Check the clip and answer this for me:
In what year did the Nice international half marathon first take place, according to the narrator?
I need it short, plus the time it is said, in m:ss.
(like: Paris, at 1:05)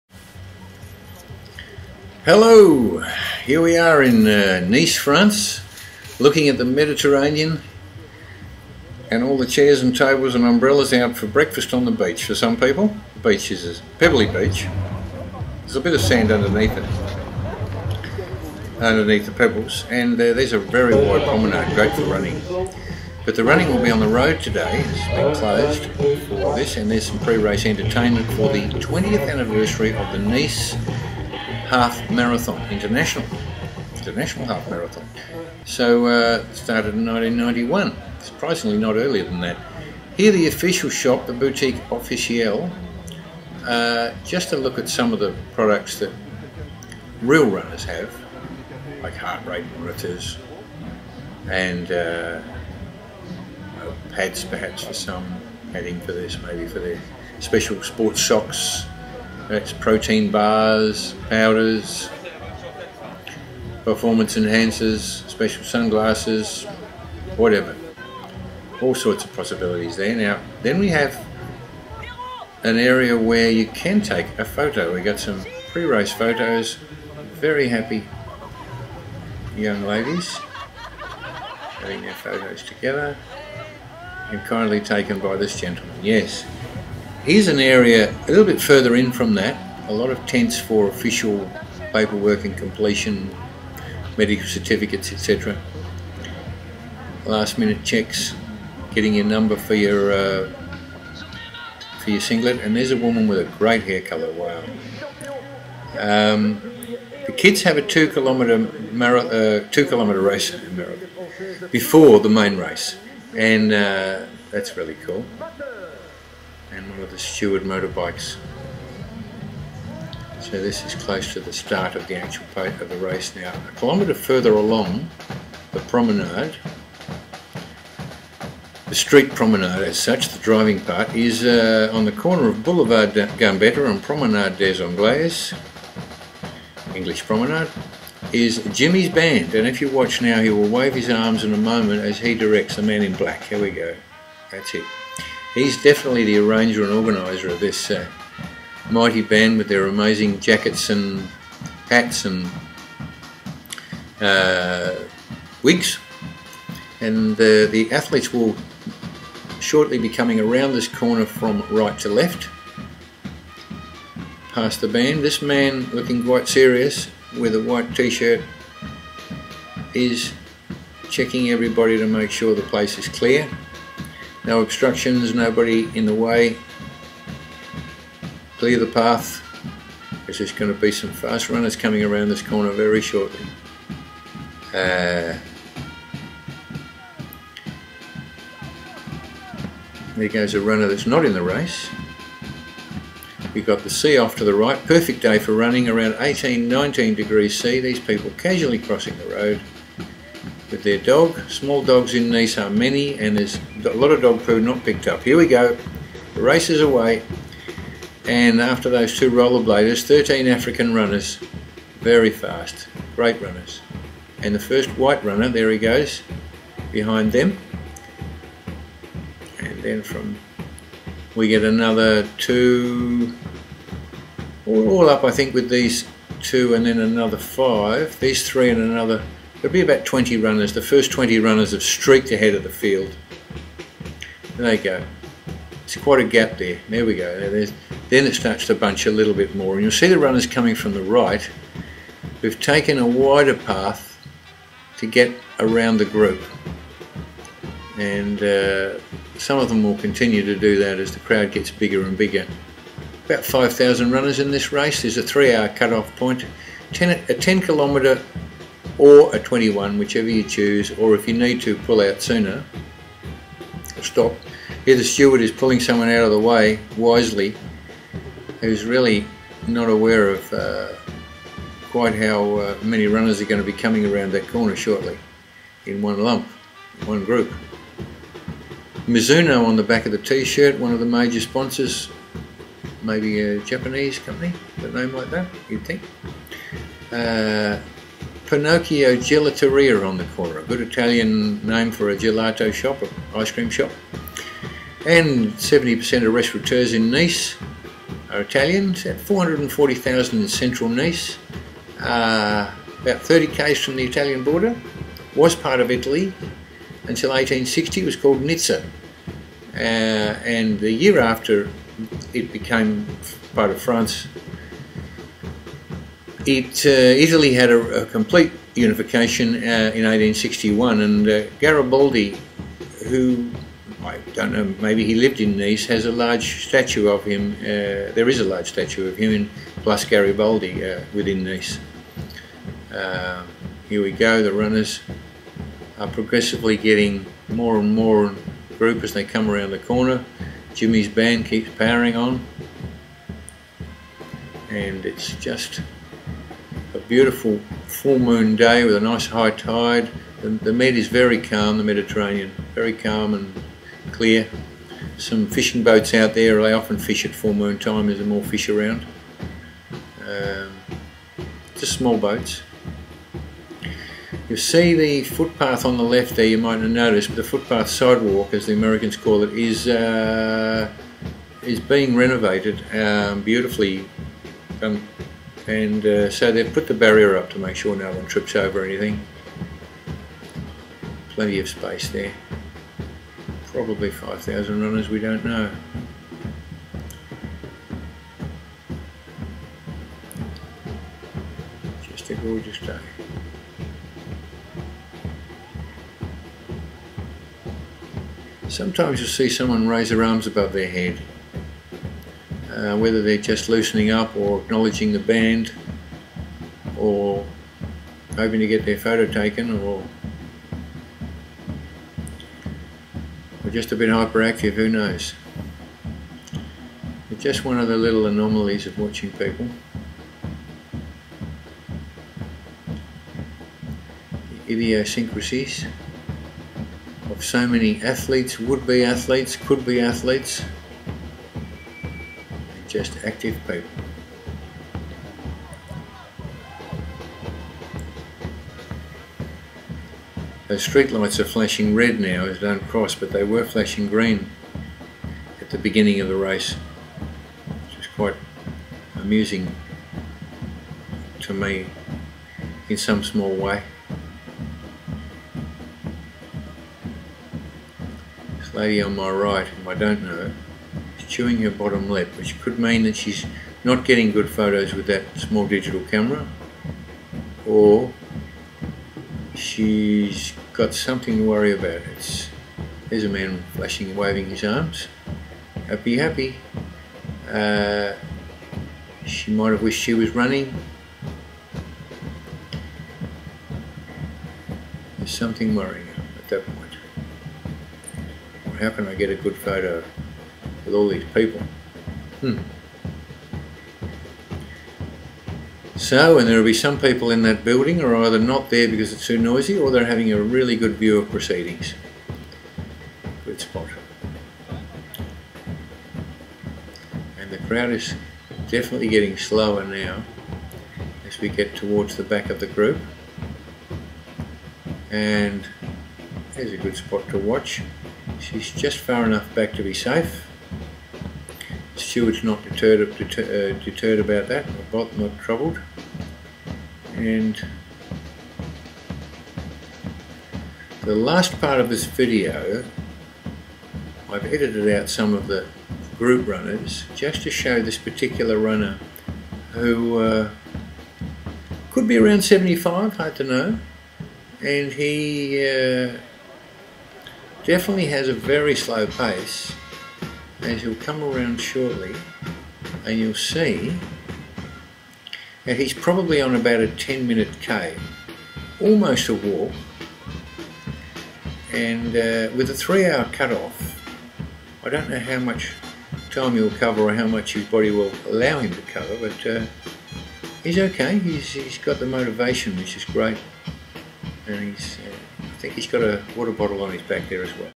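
1991, at 0:37.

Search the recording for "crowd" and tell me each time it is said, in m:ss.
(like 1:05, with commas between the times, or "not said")
4:11, 8:27.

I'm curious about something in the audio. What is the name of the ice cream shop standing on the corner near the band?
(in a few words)
Pinocchio Gelateria.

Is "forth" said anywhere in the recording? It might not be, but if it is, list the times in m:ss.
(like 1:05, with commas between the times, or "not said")
not said.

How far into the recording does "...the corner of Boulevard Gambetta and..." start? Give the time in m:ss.
2:12.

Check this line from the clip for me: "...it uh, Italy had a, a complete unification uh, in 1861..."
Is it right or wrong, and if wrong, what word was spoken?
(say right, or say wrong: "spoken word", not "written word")
right.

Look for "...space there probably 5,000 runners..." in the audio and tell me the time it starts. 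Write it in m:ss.
6:21.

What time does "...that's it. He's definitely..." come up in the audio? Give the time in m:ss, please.
2:24.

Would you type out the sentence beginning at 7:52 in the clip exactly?
It's, there's a man flashing and waving his arms.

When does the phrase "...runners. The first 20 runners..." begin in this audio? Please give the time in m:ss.
3:50.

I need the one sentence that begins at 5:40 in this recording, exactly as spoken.
Jimmy's band keeps powering on and it's just a beautiful full moon day with a nice high tide.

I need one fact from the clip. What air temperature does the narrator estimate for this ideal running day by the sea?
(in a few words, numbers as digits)
18-19 degrees C.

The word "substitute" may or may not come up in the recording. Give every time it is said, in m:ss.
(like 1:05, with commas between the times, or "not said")
not said.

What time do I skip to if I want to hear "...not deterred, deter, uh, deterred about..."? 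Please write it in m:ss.
8:42.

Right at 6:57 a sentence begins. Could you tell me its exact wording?
It's just one of the little anomalies of watching people.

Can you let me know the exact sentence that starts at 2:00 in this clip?
So this is close to the start of the actual part of the race now.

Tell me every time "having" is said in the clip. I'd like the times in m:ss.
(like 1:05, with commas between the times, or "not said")
1:21, 8:20.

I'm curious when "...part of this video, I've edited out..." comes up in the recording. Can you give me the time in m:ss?
8:51.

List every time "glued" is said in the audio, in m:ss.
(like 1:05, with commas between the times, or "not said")
not said.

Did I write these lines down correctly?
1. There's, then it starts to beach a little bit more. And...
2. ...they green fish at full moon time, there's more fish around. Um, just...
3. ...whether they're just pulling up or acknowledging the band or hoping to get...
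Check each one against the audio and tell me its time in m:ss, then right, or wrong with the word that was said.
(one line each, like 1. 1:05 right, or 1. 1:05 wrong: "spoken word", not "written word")
1. 3:57 wrong: "bunch", not "beach"
2. 5:56 wrong: "often", not "green"
3. 6:42 wrong: "loosening", not "pulling".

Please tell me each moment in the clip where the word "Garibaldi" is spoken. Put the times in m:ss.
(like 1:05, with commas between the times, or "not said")
5:21, 5:30.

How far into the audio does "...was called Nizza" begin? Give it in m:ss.
5:08.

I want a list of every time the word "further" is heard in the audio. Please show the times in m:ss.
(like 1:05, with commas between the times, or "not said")
1:28, 2:04.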